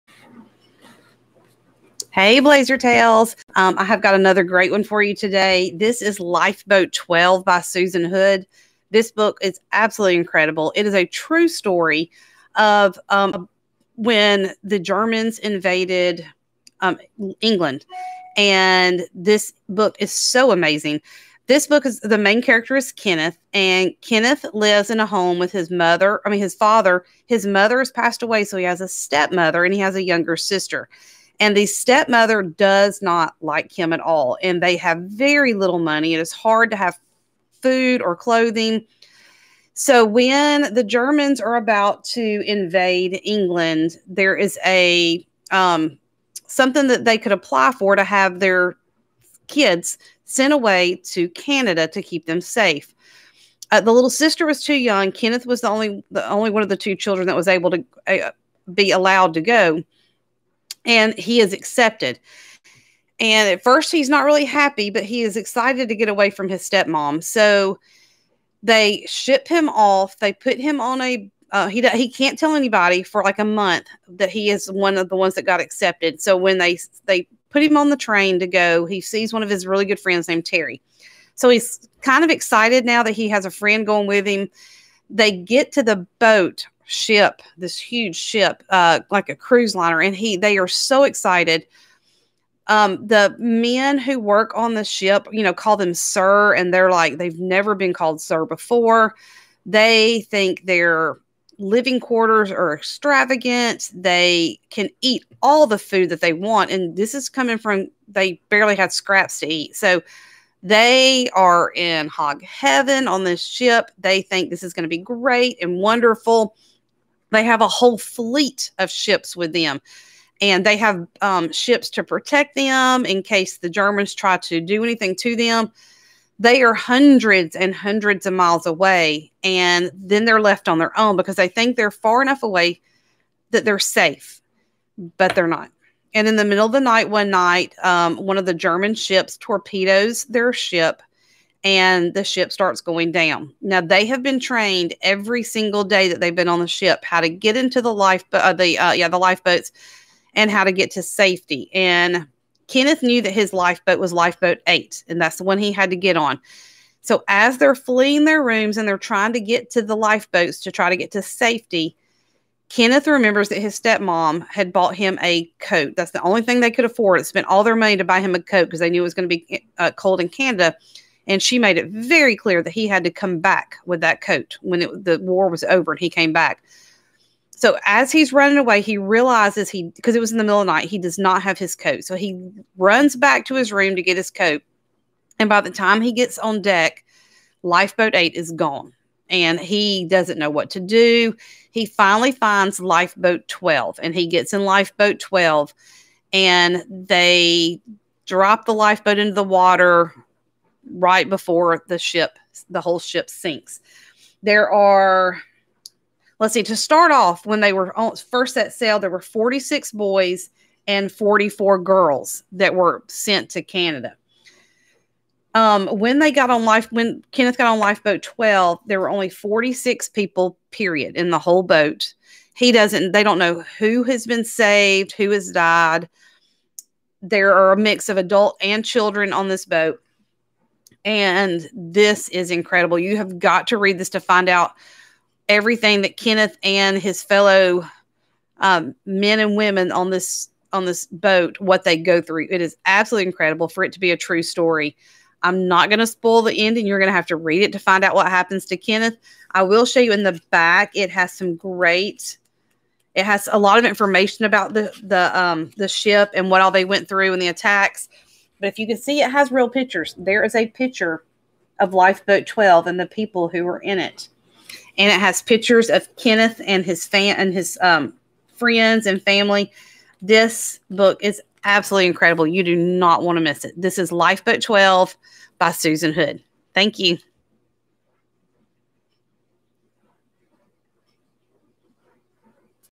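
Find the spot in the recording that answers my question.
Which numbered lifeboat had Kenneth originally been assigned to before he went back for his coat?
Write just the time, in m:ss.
2:34.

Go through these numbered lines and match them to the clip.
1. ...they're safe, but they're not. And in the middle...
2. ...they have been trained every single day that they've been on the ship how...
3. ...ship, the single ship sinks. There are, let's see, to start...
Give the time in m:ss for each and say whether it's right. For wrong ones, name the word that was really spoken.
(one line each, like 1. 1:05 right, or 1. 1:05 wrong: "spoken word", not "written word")
1. 2:13 right
2. 2:23 right
3. 3:21 wrong: "whole", not "single".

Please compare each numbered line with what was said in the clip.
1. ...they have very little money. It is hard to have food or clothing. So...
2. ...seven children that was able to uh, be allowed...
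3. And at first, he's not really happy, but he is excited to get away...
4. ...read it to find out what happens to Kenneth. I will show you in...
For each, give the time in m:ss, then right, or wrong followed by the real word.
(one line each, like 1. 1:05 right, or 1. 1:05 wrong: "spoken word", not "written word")
1. 0:34 right
2. 0:56 wrong: "two", not "seven"
3. 1:03 right
4. 4:07 right.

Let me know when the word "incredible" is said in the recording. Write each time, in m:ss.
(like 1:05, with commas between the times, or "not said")
0:10, 3:52, 4:03, 4:32.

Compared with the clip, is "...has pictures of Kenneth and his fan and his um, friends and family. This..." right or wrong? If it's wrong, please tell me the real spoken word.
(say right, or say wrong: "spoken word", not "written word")
right.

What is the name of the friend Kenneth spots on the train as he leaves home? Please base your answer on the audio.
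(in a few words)
Terry.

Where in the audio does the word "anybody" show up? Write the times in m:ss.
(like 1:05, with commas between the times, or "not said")
1:12.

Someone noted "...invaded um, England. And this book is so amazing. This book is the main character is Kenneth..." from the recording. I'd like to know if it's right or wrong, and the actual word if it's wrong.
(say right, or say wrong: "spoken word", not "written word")
right.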